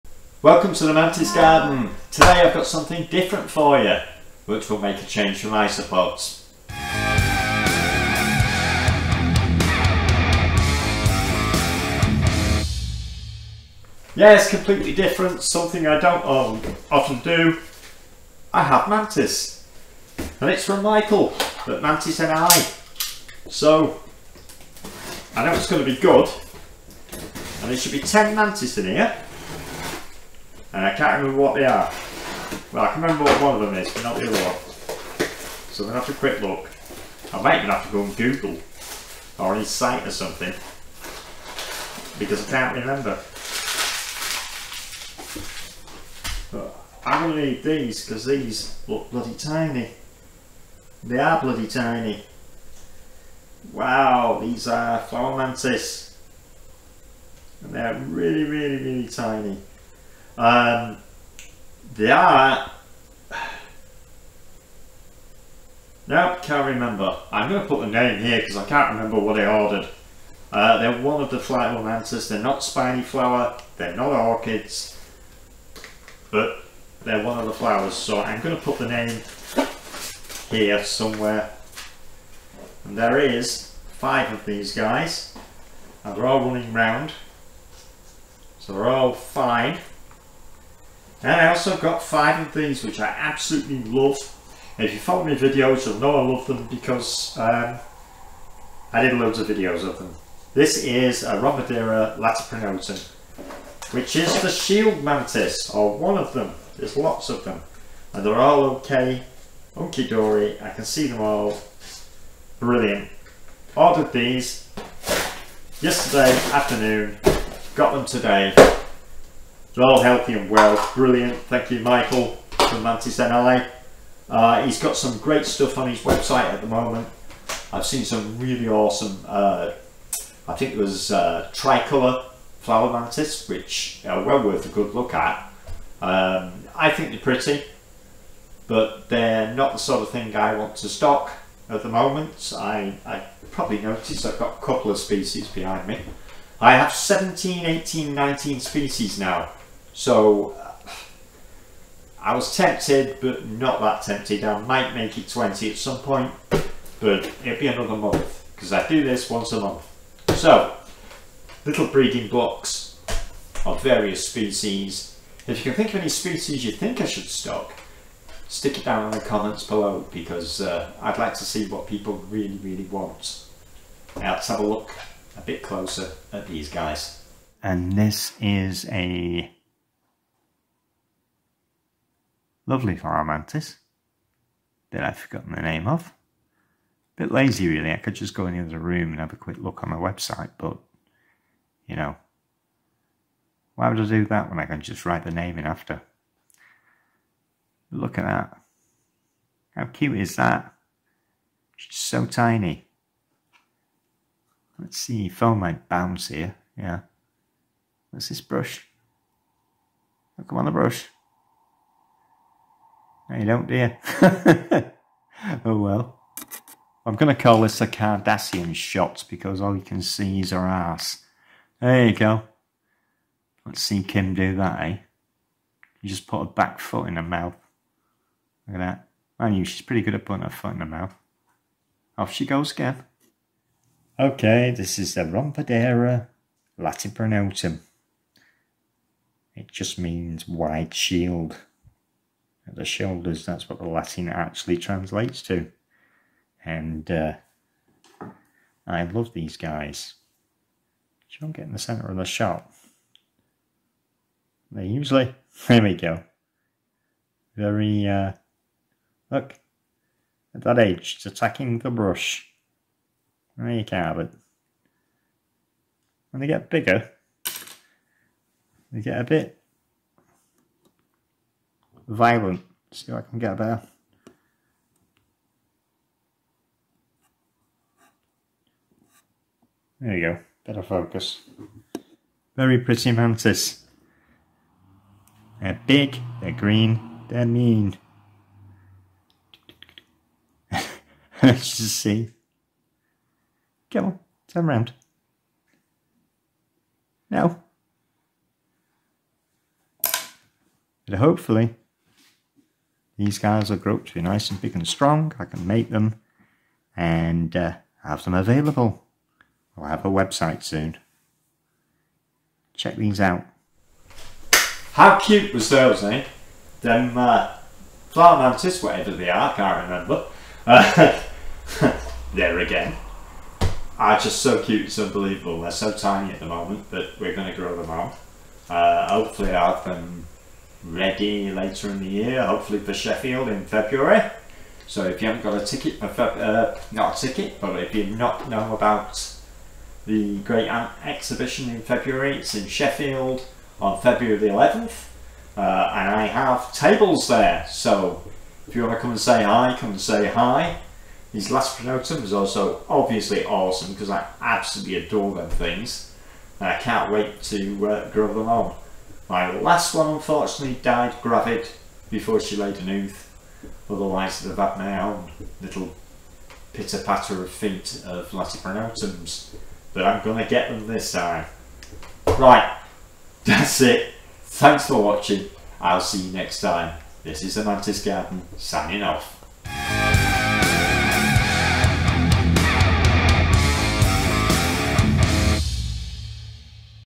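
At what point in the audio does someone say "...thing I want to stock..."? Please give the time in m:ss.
2:20.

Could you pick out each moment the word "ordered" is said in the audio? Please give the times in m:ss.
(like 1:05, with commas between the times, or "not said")
1:09, 1:53.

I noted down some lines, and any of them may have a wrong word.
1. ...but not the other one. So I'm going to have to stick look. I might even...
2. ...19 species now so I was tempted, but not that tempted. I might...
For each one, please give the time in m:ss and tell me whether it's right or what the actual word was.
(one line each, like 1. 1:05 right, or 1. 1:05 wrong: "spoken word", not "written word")
1. 0:33 wrong: "quick", not "stick"
2. 2:28 right.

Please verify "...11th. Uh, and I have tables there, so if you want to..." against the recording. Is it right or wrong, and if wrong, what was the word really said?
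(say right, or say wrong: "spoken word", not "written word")
right.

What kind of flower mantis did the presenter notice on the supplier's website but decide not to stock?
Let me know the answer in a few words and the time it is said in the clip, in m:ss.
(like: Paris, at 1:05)
tricolour flower mantis, at 2:11.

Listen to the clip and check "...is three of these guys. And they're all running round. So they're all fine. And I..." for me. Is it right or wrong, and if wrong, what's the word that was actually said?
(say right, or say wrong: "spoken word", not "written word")
wrong: "five", not "three".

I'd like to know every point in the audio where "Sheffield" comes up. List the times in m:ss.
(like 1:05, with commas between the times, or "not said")
5:32, 5:42.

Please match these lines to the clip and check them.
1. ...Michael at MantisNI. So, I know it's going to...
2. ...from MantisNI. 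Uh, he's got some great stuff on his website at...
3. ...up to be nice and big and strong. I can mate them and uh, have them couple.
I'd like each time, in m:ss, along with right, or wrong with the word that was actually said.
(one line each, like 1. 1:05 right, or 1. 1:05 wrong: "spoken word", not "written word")
1. 0:20 right
2. 2:02 right
3. 5:03 wrong: "available", not "couple".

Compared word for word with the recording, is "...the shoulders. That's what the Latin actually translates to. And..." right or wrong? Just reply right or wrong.
right.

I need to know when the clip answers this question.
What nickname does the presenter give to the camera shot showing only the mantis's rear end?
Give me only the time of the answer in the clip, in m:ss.
3:37.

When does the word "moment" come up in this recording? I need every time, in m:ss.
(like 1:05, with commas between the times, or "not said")
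2:06, 2:21, 5:26.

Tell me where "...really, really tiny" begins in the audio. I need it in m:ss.
0:58.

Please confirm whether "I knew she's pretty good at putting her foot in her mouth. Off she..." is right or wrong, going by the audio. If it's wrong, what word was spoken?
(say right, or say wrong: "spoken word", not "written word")
right.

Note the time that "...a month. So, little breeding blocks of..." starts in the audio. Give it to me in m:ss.
2:39.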